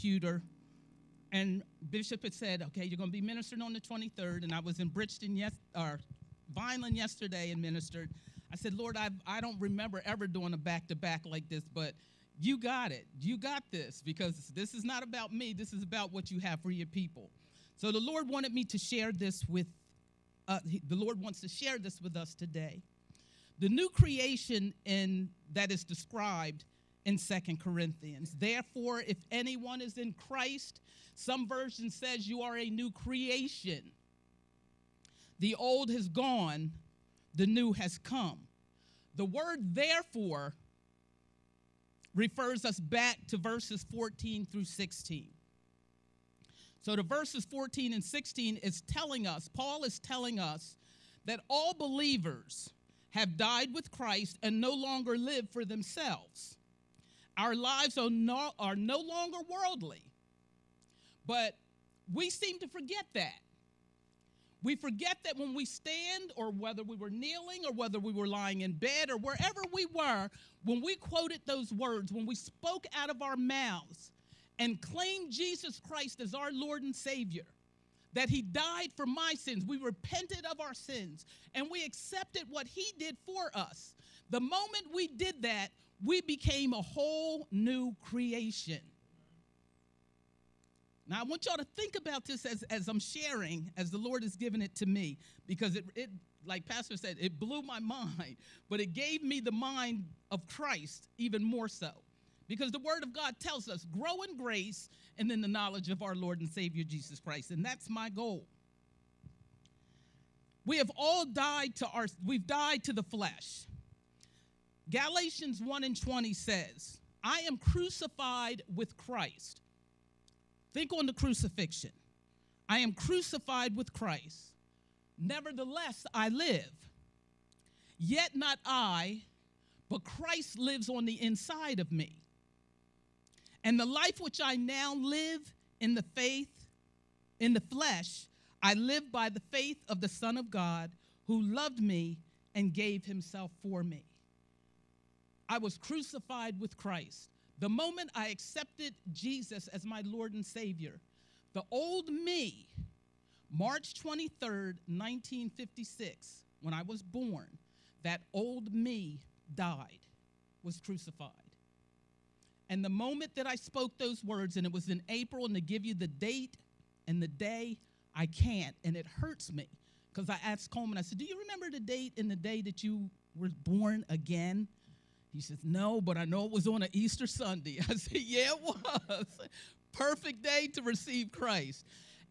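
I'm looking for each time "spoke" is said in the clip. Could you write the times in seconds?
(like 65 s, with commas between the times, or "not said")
72 s, 163 s.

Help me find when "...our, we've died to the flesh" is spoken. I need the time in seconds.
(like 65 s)
111 s.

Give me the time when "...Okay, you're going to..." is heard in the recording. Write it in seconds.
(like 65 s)
2 s.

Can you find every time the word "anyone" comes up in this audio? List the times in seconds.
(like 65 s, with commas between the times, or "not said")
29 s.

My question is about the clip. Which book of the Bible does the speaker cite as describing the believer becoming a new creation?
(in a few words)
Second Corinthians.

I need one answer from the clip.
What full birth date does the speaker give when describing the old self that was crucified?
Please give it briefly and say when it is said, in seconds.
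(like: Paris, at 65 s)
March 23, 1956, at 153 s.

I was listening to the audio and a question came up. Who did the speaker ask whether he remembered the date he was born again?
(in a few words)
Coleman.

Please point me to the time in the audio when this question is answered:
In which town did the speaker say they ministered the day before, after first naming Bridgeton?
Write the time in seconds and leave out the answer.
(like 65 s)
6 s.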